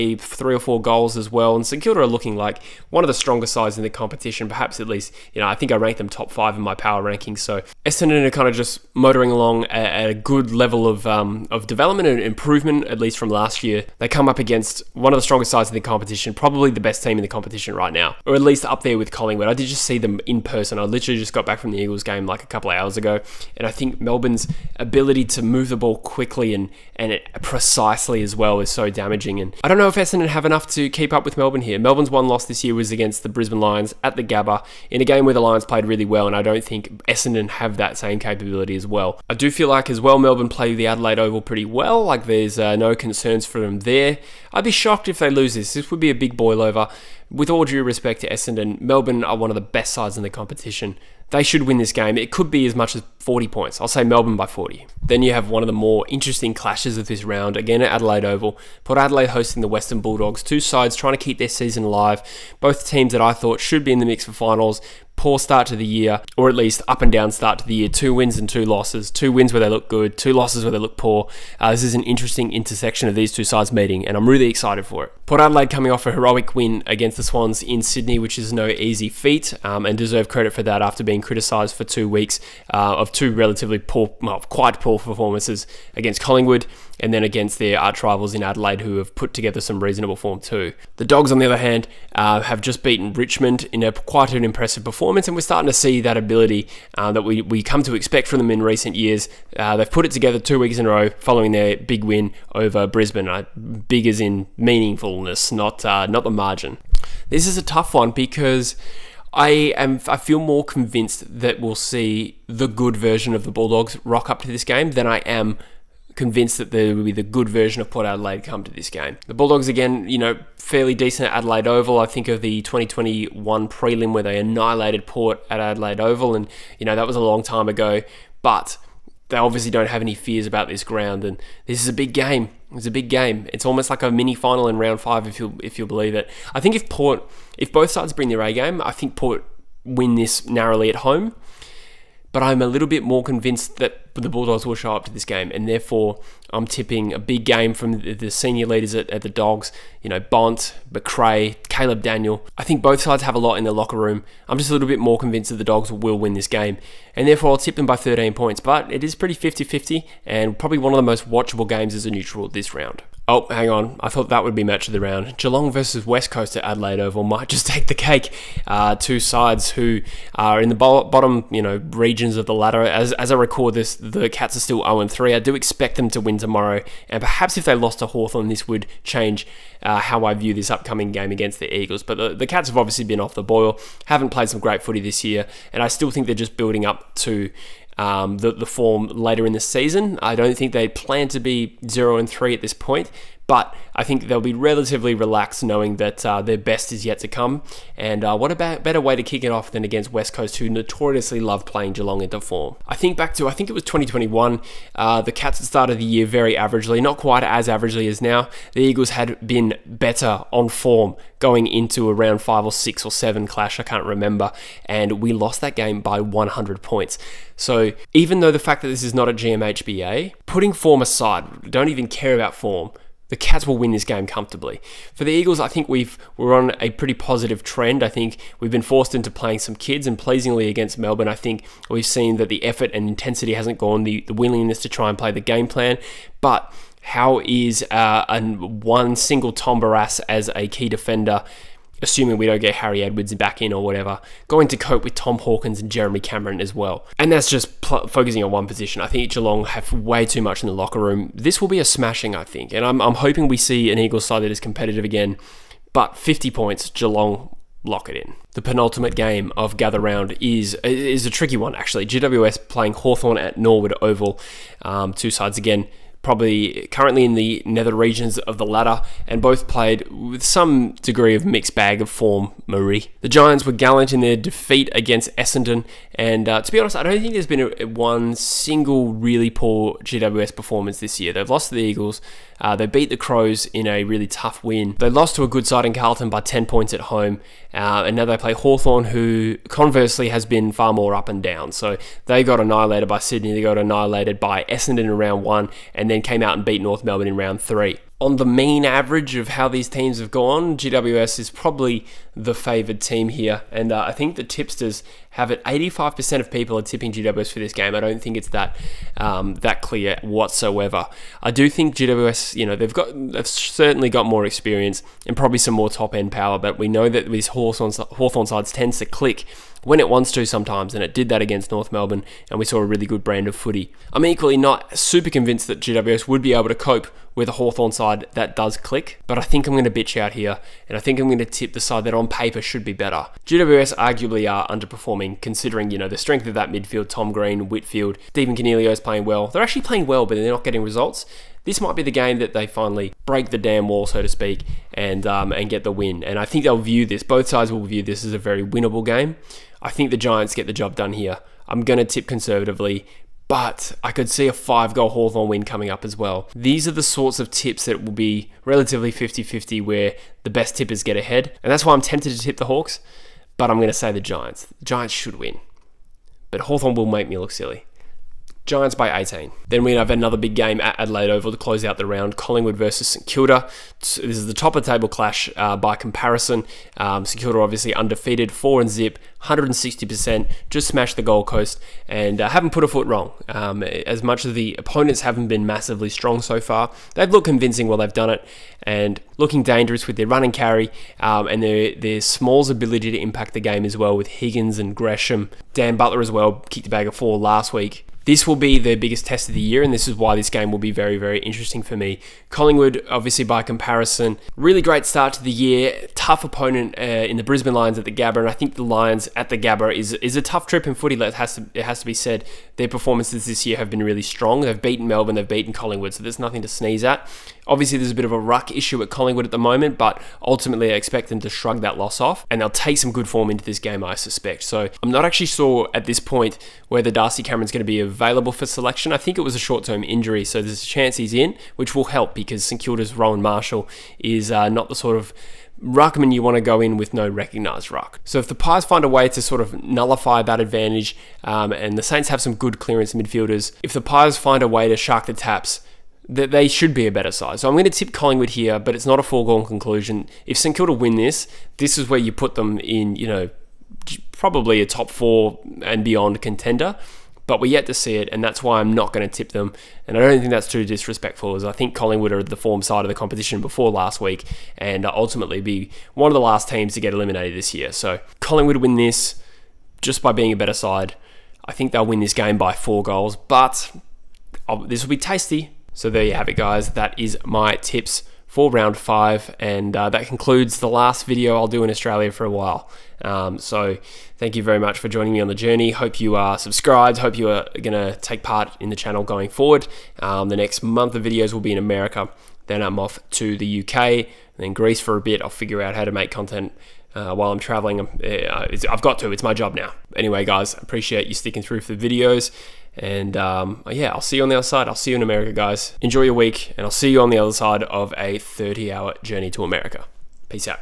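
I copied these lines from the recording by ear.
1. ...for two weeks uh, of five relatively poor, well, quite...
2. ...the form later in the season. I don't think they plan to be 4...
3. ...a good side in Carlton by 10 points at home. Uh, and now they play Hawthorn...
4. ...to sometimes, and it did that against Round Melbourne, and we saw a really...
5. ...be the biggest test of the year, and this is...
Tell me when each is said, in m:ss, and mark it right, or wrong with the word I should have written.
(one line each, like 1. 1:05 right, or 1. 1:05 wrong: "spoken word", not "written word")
1. 1:21 wrong: "two", not "five"
2. 3:08 wrong: "0", not "4"
3. 4:45 right
4. 5:20 wrong: "North", not "Round"
5. 6:38 right.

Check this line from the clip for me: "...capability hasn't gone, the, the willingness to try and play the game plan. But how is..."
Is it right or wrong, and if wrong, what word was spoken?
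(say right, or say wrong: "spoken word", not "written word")
wrong: "intensity", not "capability".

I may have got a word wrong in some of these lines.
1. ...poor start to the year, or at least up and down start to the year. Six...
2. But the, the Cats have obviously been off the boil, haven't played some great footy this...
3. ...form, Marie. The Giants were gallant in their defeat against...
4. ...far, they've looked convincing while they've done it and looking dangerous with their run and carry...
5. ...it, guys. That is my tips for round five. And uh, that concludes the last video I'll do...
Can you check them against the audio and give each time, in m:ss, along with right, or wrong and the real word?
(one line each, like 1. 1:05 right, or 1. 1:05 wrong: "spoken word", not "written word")
1. 1:05 wrong: "Two", not "Six"
2. 3:02 right
3. 4:32 right
4. 6:26 right
5. 7:56 right.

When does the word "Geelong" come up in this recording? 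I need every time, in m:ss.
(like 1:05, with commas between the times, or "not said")
2:45, 3:21, 4:09, 4:16.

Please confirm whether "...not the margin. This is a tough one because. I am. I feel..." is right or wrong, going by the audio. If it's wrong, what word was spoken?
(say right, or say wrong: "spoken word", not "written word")
right.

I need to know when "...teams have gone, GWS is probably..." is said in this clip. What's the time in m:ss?
4:59.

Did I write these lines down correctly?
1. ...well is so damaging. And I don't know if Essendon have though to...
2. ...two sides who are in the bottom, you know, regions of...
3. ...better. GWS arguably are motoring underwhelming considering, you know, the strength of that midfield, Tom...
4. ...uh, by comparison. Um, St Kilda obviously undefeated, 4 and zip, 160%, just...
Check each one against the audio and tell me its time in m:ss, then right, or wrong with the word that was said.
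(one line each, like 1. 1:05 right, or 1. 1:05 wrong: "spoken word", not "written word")
1. 0:28 wrong: "enough", not "though"
2. 2:48 right
3. 5:32 wrong: "underperforming", not "motoring"
4. 6:15 right.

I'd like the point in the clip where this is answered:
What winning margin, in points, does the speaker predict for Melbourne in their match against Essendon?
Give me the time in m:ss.
0:54.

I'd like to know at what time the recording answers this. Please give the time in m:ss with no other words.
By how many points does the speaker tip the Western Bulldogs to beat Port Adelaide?
2:37.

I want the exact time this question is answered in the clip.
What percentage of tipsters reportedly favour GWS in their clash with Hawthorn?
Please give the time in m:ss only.
5:05.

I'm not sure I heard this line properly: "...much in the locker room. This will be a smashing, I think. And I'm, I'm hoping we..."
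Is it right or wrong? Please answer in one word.
right.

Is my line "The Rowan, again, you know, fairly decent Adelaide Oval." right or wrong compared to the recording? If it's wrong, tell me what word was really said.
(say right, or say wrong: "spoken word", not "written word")
wrong: "Bulldogs", not "Rowan".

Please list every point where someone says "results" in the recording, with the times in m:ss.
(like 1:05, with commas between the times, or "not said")
5:40.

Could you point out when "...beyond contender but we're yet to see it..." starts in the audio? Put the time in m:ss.
7:36.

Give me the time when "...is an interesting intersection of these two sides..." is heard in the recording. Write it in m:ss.
1:11.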